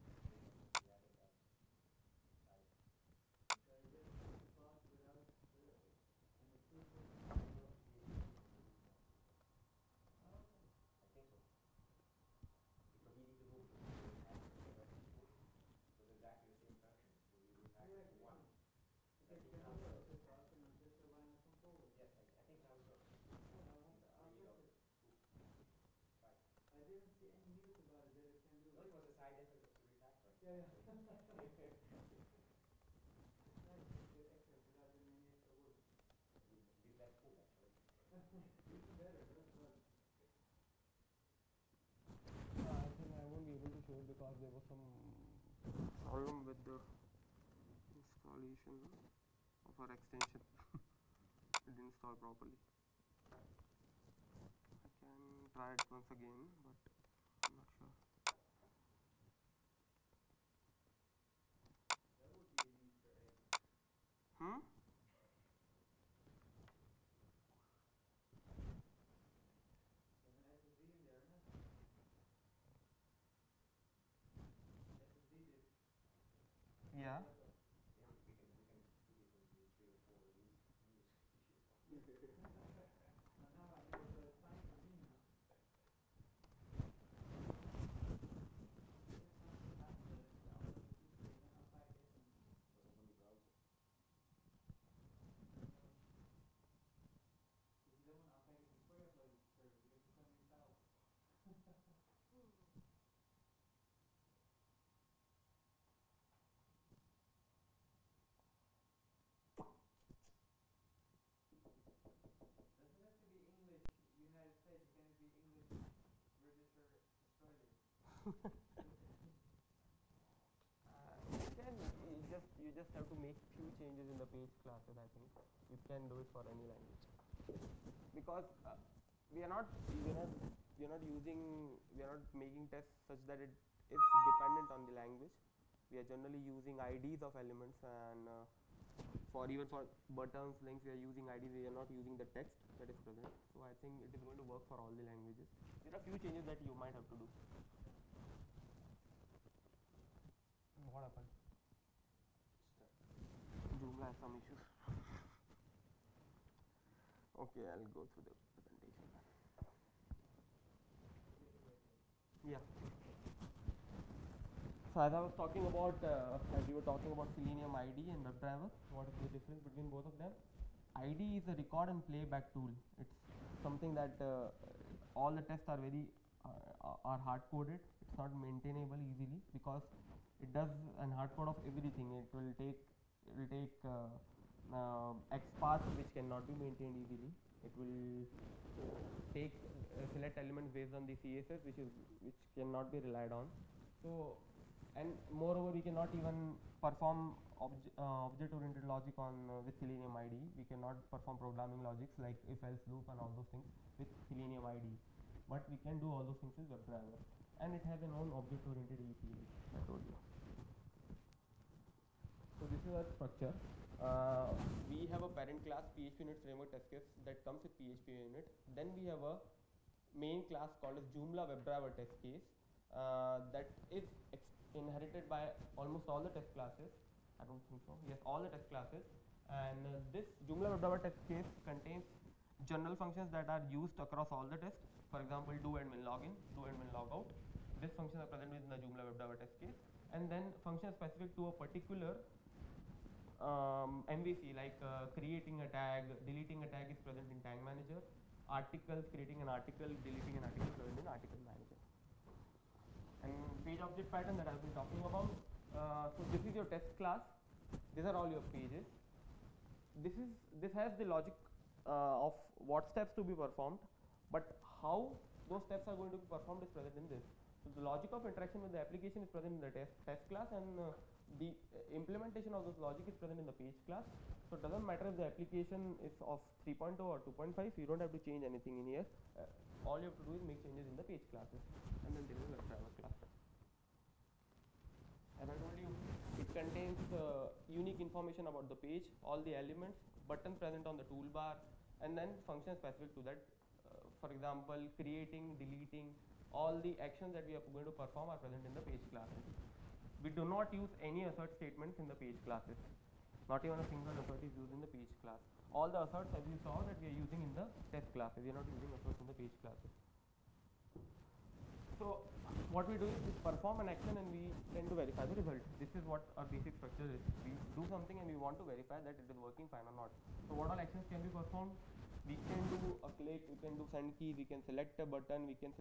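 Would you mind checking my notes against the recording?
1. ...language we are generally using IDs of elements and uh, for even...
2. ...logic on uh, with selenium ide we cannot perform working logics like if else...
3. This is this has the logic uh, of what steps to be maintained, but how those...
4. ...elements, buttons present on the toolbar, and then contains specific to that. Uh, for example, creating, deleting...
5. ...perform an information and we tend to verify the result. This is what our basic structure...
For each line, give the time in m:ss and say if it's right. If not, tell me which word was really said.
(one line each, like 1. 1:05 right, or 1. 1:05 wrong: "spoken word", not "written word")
1. 2:15 right
2. 3:18 wrong: "programming", not "working"
3. 4:20 wrong: "performed", not "maintained"
4. 4:49 wrong: "functions", not "contains"
5. 5:13 wrong: "action", not "information".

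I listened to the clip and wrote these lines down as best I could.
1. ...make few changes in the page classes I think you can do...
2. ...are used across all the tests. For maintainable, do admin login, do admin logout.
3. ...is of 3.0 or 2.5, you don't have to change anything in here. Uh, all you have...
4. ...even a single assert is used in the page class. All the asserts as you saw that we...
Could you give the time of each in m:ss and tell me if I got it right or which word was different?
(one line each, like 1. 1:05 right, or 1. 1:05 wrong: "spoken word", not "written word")
1. 2:03 right
2. 3:53 wrong: "example", not "maintainable"
3. 4:36 right
4. 5:03 right.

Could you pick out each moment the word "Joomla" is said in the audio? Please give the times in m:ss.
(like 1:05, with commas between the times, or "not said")
2:33, 3:41, 3:50, 3:58.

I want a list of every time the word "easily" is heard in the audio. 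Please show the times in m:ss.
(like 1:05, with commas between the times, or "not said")
2:59, 3:07.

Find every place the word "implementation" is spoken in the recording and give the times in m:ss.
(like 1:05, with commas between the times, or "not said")
4:31.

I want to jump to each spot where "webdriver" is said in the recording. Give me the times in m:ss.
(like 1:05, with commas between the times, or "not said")
2:48, 3:26, 3:41, 3:50, 3:59.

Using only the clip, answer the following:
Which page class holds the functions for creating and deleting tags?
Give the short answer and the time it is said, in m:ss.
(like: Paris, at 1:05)
tag manager, at 4:07.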